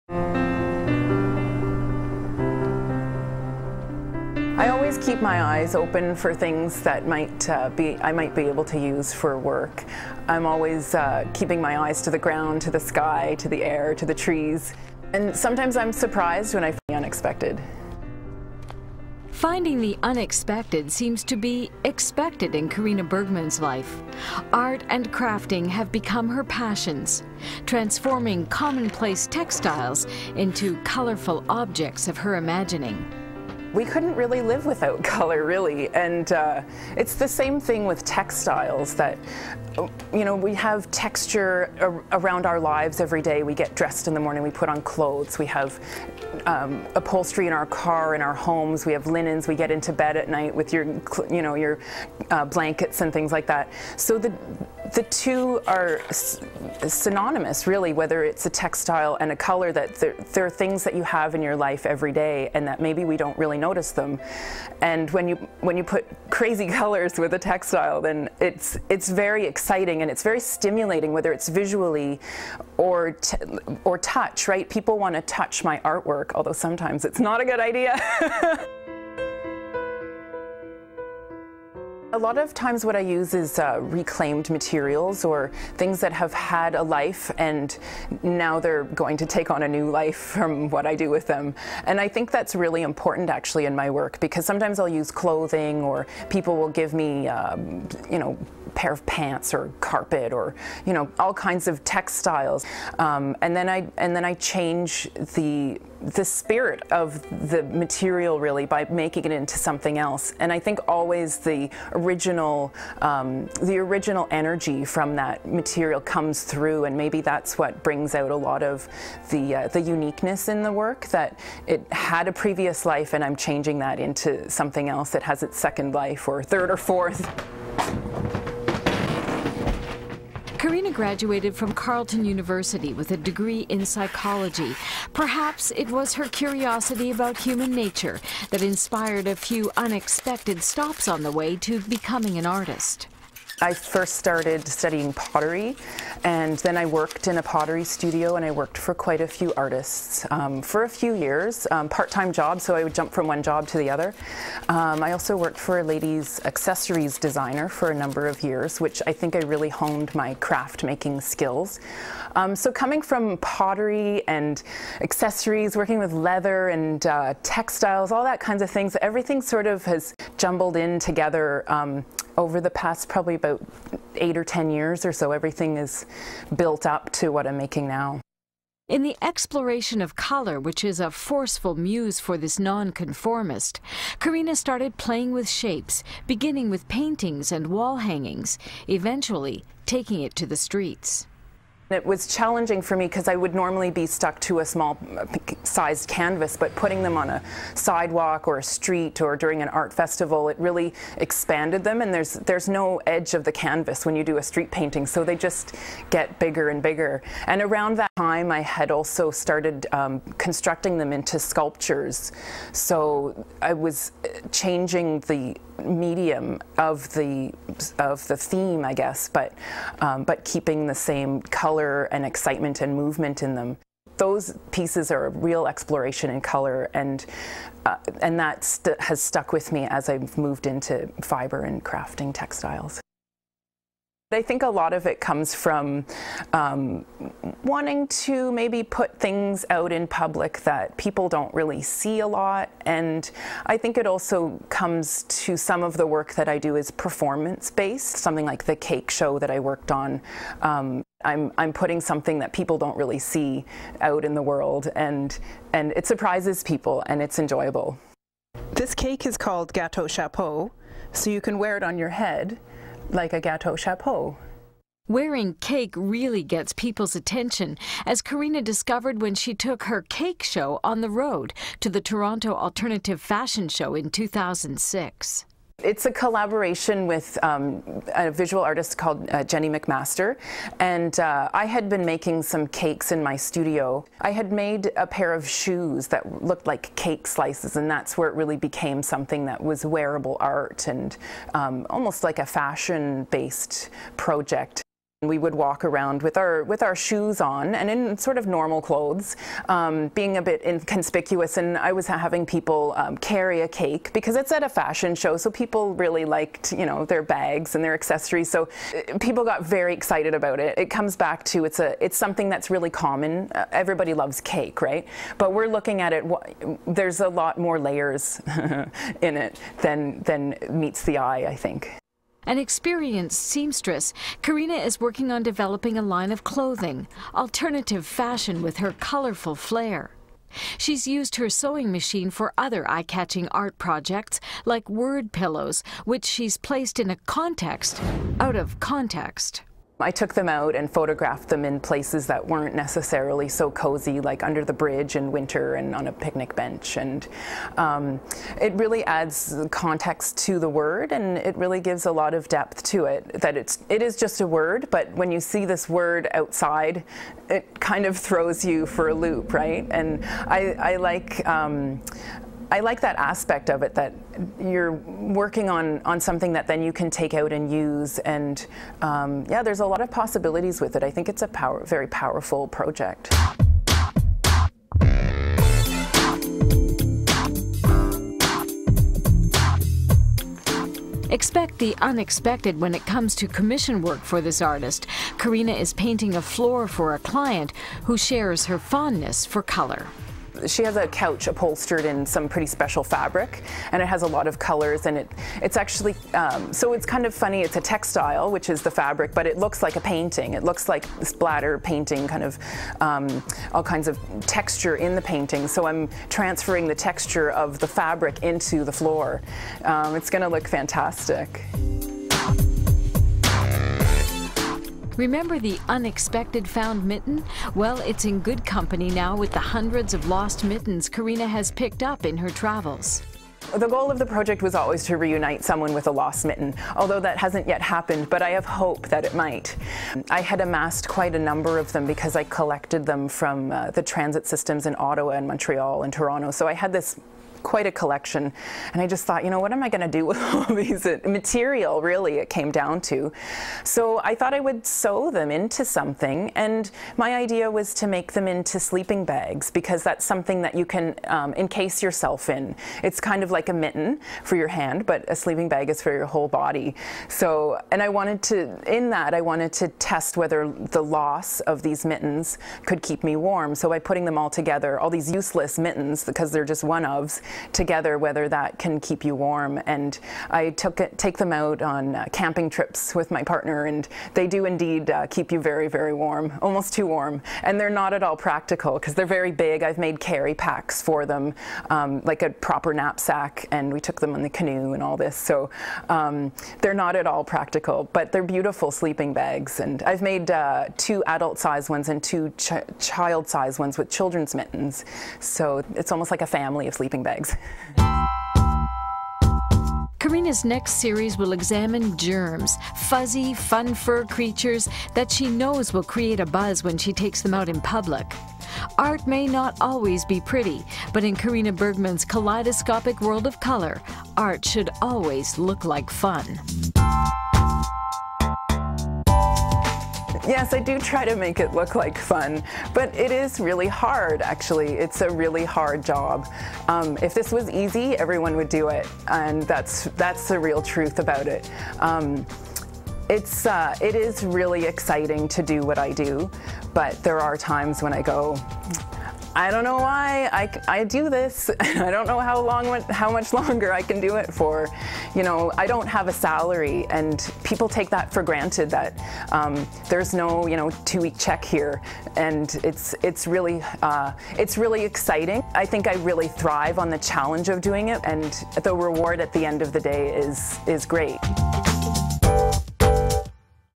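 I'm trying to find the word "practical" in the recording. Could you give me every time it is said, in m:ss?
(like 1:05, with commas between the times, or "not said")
7:58, 8:07.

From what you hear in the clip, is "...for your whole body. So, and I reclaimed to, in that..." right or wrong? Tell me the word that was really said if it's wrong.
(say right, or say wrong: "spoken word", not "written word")
wrong: "wanted", not "reclaimed".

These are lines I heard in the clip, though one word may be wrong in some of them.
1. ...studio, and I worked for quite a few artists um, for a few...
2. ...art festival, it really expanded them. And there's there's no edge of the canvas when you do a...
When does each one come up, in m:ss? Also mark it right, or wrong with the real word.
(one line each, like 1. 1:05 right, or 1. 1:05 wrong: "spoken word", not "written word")
1. 2:27 right
2. 3:19 right.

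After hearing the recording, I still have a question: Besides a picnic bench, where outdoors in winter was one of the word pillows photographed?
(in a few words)
under the bridge.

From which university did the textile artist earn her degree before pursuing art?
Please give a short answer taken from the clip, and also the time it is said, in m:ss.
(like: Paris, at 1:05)
Carleton University, at 2:11.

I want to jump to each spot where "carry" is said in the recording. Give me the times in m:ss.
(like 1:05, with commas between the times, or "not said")
5:03, 8:00.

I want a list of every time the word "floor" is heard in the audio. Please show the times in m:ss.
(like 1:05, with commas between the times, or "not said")
6:26, 6:48.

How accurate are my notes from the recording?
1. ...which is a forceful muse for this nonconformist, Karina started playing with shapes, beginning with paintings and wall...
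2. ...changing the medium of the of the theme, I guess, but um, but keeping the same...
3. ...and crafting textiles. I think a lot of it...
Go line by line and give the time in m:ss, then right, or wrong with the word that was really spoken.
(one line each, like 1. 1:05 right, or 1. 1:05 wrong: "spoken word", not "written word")
1. 3:00 right
2. 3:34 right
3. 3:51 right.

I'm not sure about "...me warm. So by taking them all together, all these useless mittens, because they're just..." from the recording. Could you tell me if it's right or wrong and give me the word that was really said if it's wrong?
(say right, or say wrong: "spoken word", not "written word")
wrong: "putting", not "taking".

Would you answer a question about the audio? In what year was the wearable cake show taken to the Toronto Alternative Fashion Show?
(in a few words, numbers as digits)
2006.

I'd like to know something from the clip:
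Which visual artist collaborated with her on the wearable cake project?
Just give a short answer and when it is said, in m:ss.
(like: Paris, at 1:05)
Jenny McMaster, at 4:39.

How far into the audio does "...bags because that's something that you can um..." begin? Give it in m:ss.
7:29.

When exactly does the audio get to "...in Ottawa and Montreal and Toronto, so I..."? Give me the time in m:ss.
7:14.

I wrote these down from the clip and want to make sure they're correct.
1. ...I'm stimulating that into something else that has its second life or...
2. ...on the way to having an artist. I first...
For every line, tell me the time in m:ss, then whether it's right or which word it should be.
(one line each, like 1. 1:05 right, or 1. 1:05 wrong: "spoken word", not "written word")
1. 2:03 wrong: "changing", not "stimulating"
2. 2:21 wrong: "becoming", not "having".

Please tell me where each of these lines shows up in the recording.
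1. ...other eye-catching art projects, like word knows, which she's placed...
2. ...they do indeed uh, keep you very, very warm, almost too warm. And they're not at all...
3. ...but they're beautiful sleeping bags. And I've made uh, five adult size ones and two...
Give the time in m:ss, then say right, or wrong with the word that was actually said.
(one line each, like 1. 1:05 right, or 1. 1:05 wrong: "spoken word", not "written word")
1. 5:32 wrong: "pillows", not "knows"
2. 7:54 right
3. 8:08 wrong: "two", not "five".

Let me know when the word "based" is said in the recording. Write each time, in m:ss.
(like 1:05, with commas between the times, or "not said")
4:07, 4:52.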